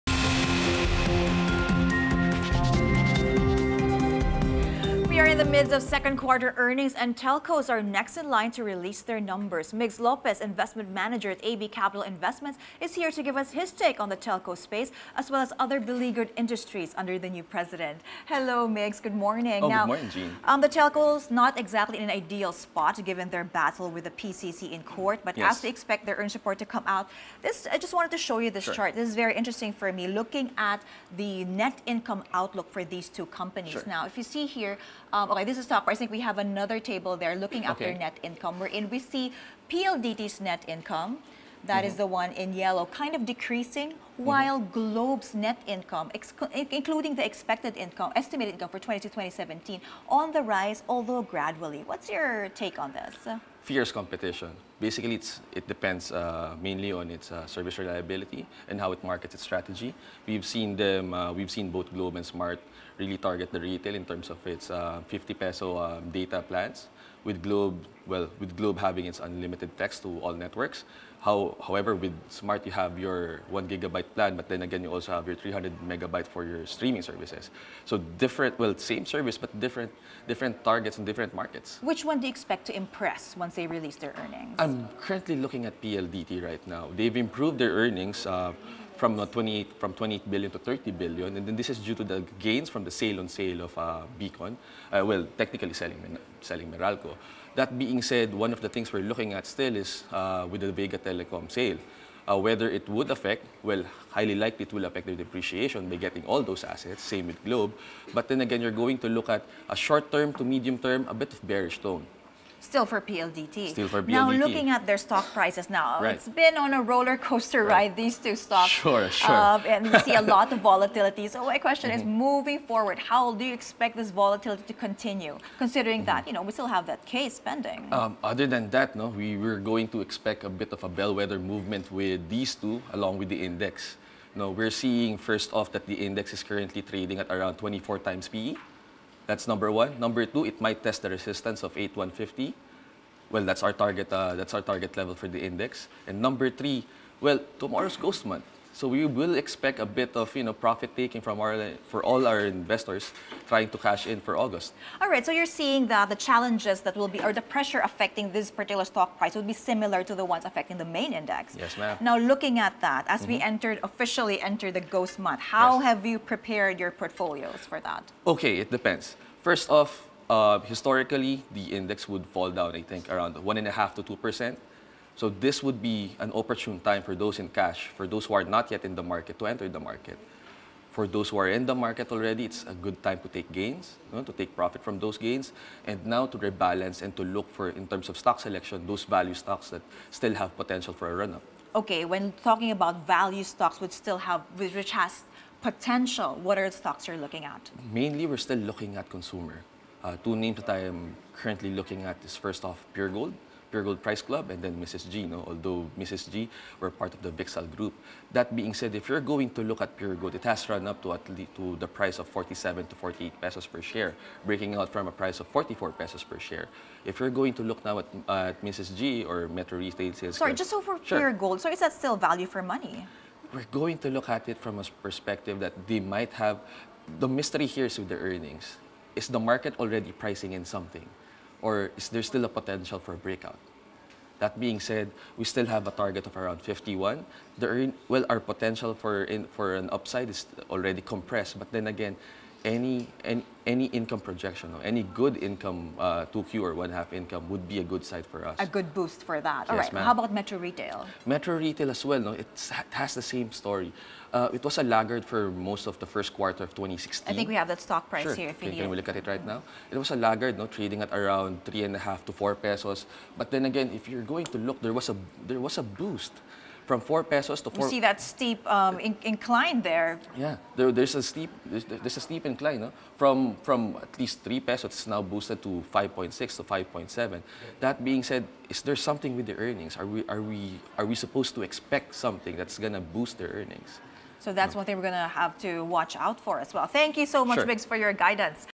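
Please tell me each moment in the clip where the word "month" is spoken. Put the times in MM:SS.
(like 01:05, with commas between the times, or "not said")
02:28, 02:45.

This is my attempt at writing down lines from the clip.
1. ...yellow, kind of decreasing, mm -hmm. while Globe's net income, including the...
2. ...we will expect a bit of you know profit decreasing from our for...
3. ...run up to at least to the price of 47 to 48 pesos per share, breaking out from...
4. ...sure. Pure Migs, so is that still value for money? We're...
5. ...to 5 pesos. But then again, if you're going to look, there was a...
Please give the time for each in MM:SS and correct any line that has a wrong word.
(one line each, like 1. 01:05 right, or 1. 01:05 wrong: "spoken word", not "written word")
1. 00:42 right
2. 02:28 wrong: "taking", not "decreasing"
3. 03:30 right
4. 03:40 wrong: "Gold", not "Migs"
5. 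04:22 wrong: "4", not "5".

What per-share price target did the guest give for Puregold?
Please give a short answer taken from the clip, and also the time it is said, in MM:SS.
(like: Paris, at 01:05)
51, at 03:56.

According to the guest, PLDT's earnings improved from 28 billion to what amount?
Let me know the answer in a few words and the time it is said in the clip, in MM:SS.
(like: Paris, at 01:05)
30 billion, at 01:30.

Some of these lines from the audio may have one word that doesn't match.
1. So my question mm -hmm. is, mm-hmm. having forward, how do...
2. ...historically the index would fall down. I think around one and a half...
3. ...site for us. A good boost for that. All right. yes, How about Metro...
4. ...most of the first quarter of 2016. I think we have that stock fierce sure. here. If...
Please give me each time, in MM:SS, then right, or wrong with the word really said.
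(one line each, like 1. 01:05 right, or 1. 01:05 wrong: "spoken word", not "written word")
1. 02:01 wrong: "moving", not "having"
2. 02:50 right
3. 04:08 right
4. 04:15 wrong: "price", not "fierce".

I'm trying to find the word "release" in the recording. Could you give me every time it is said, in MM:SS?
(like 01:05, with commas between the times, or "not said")
00:08, 01:23.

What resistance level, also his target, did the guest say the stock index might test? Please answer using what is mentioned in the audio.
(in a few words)
8150.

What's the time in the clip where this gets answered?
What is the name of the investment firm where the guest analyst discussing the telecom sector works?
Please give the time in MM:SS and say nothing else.
00:11.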